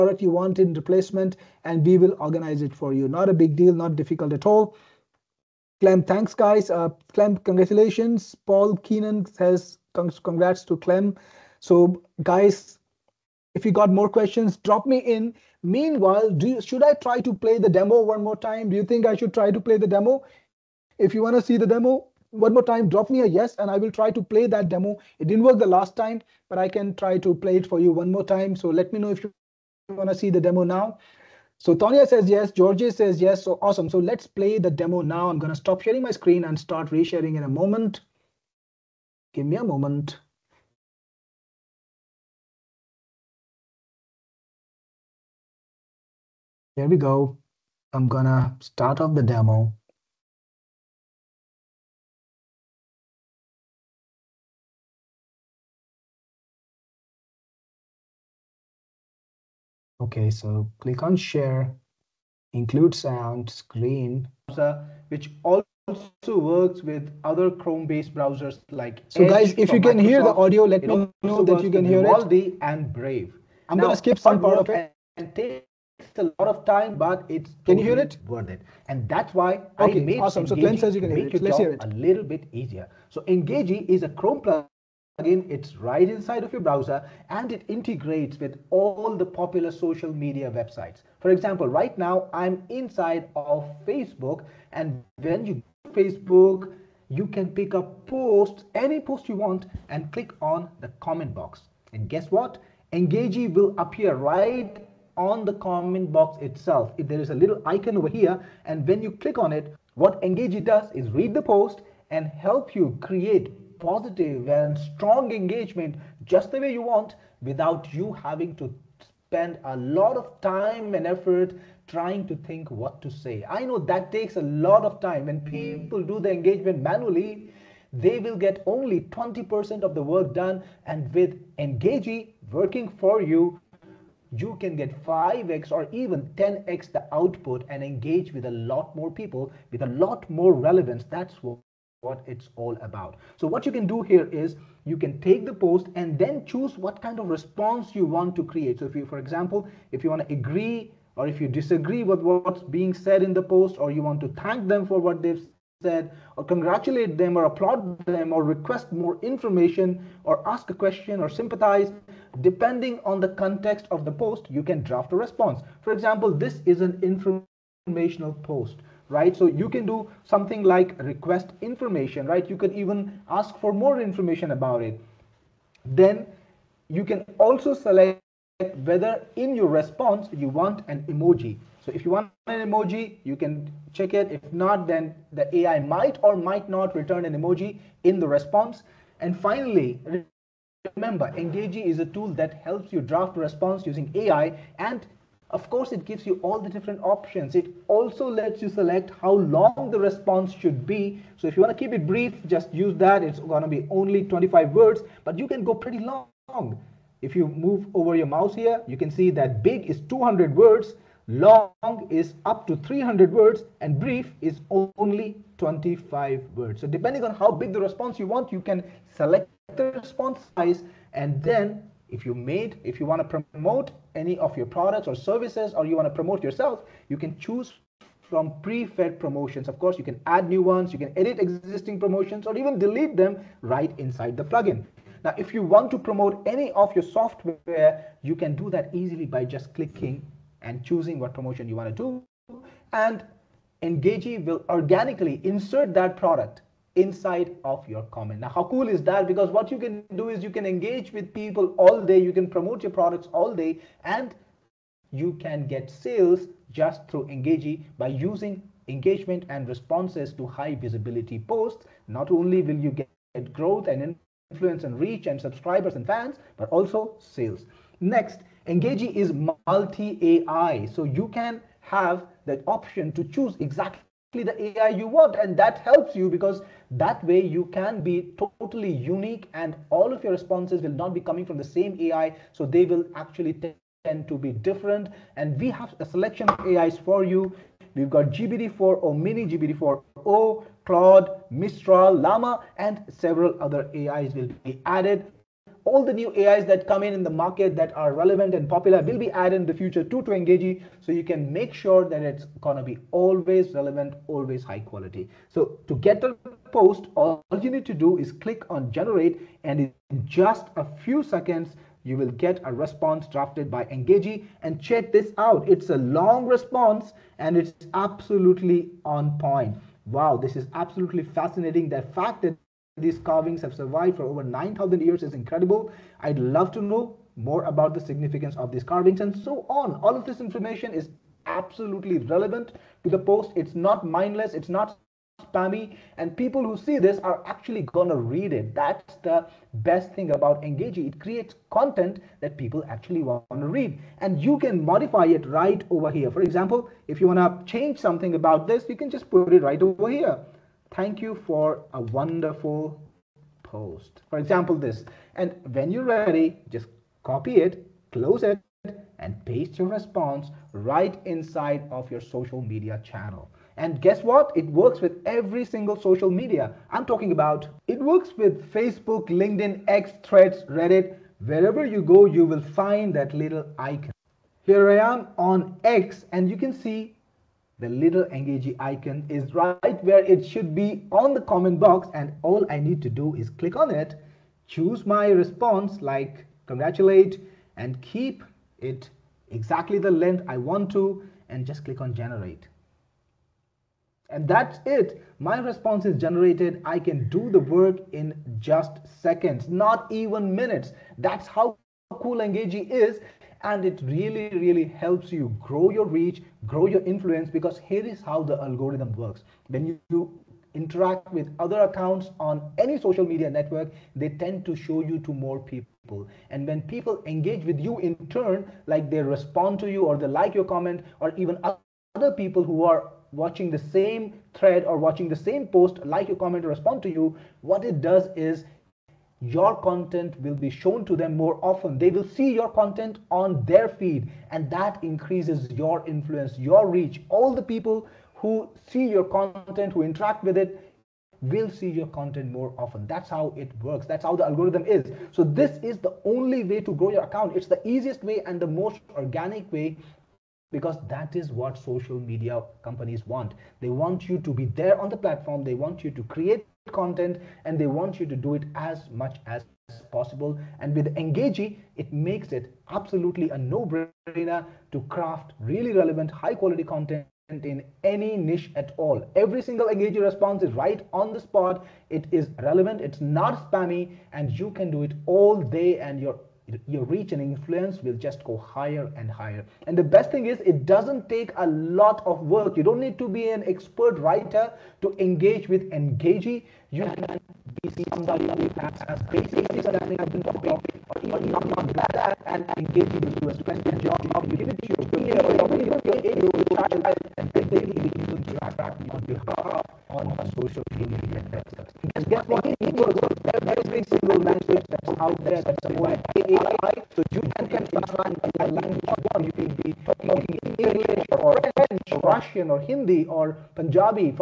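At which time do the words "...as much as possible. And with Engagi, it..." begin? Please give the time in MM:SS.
07:38.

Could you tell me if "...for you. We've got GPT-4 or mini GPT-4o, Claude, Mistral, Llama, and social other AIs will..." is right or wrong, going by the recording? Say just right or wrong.
wrong.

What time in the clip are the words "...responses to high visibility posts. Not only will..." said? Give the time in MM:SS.
04:19.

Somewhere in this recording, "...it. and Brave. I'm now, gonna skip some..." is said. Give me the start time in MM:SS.
01:12.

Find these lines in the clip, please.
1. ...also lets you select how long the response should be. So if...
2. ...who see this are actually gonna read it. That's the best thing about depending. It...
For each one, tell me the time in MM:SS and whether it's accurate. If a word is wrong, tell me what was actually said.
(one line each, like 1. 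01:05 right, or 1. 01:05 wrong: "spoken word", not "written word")
1. 03:17 right
2. 05:36 wrong: "engaging", not "depending".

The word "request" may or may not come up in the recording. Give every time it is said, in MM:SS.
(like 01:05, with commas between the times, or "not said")
02:38, 02:51.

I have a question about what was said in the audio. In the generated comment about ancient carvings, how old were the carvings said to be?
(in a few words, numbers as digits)
over 9,000 years.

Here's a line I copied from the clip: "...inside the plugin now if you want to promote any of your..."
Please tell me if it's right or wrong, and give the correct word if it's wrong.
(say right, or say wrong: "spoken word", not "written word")
right.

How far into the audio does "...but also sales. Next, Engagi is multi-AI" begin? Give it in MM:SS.
04:26.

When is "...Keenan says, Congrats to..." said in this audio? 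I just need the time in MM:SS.
00:08.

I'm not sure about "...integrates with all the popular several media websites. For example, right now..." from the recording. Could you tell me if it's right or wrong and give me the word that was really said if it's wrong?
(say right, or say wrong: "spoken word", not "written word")
wrong: "social", not "several".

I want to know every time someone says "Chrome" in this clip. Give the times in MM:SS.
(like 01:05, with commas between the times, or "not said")
01:07, 01:24.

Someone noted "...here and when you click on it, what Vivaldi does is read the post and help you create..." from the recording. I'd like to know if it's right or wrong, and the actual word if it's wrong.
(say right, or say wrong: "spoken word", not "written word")
wrong: "Engagi", not "Vivaldi".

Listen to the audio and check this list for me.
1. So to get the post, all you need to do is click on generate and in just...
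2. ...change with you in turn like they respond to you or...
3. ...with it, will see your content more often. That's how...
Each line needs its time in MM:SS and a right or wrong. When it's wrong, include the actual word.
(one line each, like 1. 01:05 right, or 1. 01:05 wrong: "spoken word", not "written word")
1. 05:05 right
2. 06:57 wrong: "engage", not "change"
3. 07:20 right.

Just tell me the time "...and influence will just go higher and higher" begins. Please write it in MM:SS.
07:57.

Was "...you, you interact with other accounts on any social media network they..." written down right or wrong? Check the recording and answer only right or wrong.
right.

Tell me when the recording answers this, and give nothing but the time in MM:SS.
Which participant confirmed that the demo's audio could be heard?
01:20.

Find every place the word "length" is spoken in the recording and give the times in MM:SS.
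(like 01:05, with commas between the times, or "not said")
06:30.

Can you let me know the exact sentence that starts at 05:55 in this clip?
And when you're ready, just copy it, close it, and paste your response right inside of your social media channel.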